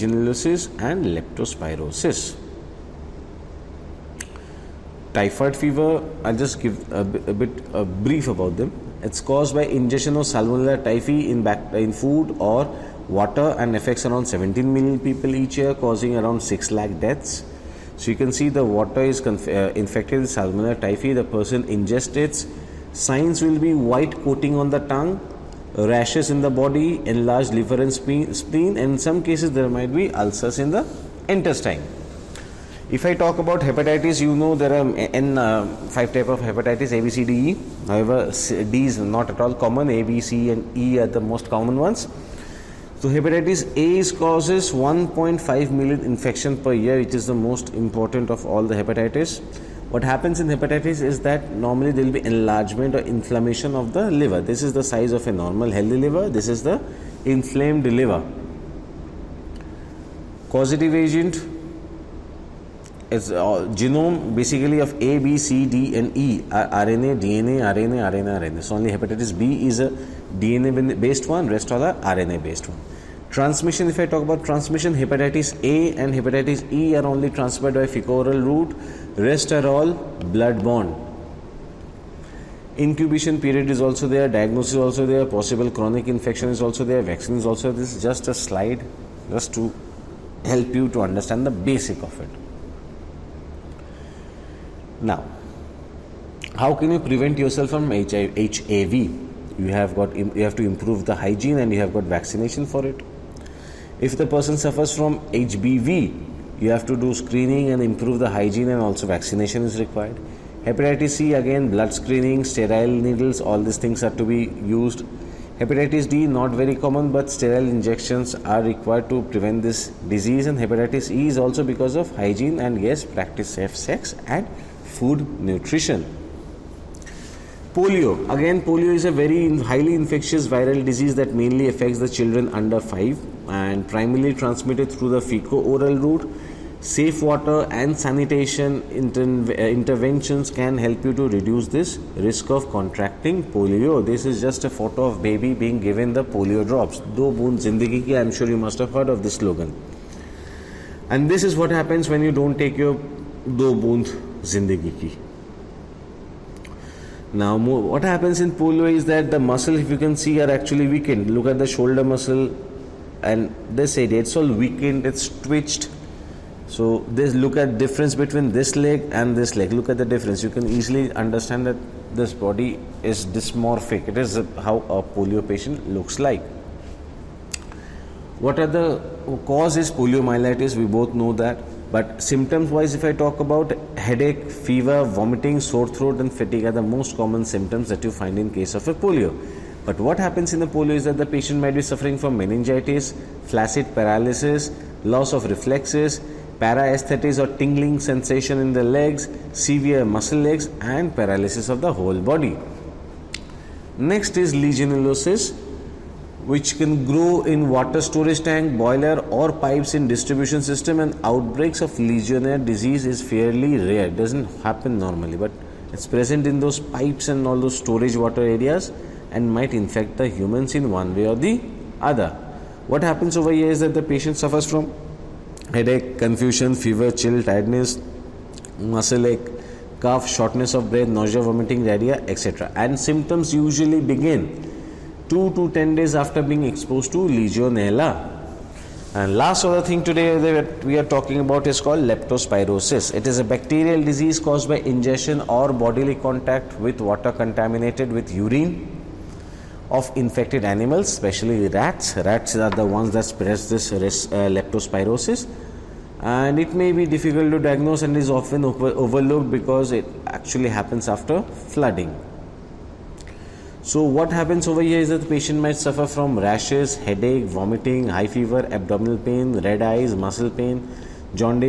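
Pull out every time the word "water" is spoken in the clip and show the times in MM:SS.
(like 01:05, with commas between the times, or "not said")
00:13, 00:18, 02:17, 03:27, 03:38, 04:06.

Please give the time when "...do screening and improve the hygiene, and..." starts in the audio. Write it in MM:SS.
01:46.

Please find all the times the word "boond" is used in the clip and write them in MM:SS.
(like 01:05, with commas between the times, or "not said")
02:27, 02:33.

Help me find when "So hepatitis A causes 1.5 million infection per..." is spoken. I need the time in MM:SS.
00:42.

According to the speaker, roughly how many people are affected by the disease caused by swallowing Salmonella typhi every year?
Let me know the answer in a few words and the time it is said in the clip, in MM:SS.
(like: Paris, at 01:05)
17 million, at 00:14.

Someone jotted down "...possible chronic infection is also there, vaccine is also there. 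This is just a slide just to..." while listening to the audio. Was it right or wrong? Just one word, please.
right.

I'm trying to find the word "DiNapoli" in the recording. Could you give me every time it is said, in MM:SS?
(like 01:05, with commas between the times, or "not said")
not said.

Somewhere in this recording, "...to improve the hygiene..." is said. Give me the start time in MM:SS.
01:40.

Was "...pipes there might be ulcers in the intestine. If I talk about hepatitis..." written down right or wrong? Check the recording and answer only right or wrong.
wrong.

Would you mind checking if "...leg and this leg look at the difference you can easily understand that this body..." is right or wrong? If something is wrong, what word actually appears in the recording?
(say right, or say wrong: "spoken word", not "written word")
right.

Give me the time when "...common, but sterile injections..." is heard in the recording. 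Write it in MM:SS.
01:56.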